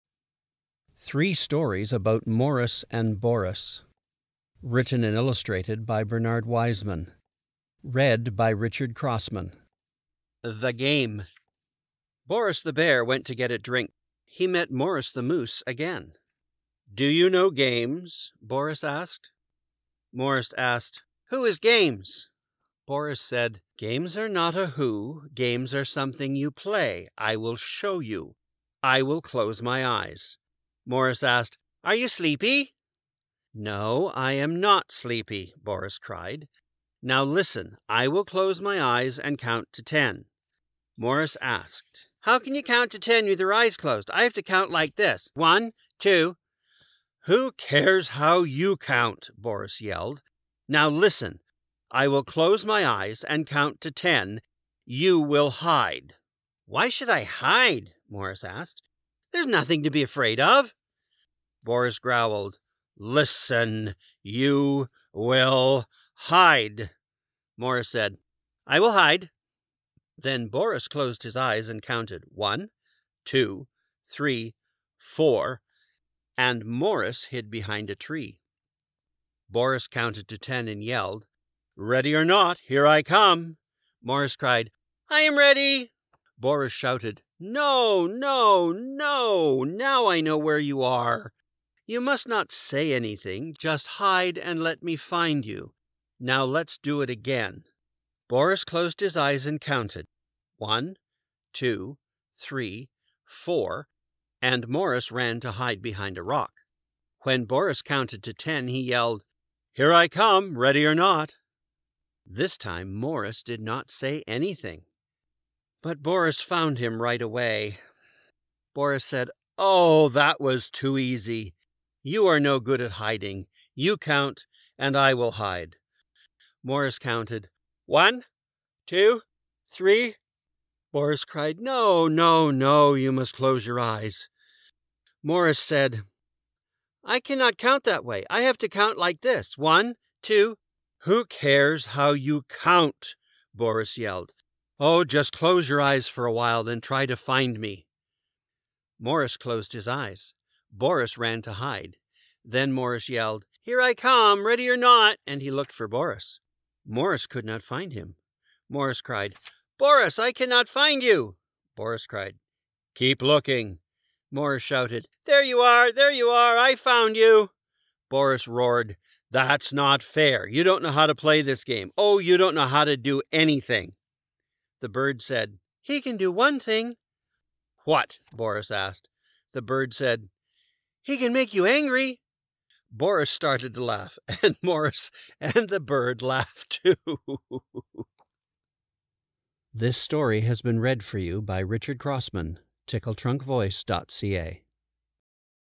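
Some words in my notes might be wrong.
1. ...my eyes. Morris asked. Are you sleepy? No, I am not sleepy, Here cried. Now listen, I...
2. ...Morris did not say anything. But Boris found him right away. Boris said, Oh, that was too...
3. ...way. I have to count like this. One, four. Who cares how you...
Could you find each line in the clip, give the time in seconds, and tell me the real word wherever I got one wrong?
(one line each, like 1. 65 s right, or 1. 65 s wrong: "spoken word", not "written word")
1. 29 s wrong: "Boris", not "Here"
2. 112 s right
3. 138 s wrong: "two", not "four".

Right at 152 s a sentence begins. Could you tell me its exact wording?
Then Morris yelled, Here I come, ready or not, and he looked for Boris.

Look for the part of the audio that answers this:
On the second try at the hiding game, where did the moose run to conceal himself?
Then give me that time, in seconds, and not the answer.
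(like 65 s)
106 s.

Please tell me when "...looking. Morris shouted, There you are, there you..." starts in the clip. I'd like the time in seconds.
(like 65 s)
163 s.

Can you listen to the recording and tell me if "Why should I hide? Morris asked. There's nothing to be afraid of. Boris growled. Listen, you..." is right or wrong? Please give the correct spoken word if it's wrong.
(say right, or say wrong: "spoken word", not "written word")
right.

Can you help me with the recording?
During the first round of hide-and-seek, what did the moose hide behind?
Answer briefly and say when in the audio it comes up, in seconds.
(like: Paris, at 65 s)
A tree, at 77 s.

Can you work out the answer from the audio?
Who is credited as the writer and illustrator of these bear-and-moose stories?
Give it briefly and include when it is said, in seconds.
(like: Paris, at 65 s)
Bernard Wiseman, at 6 s.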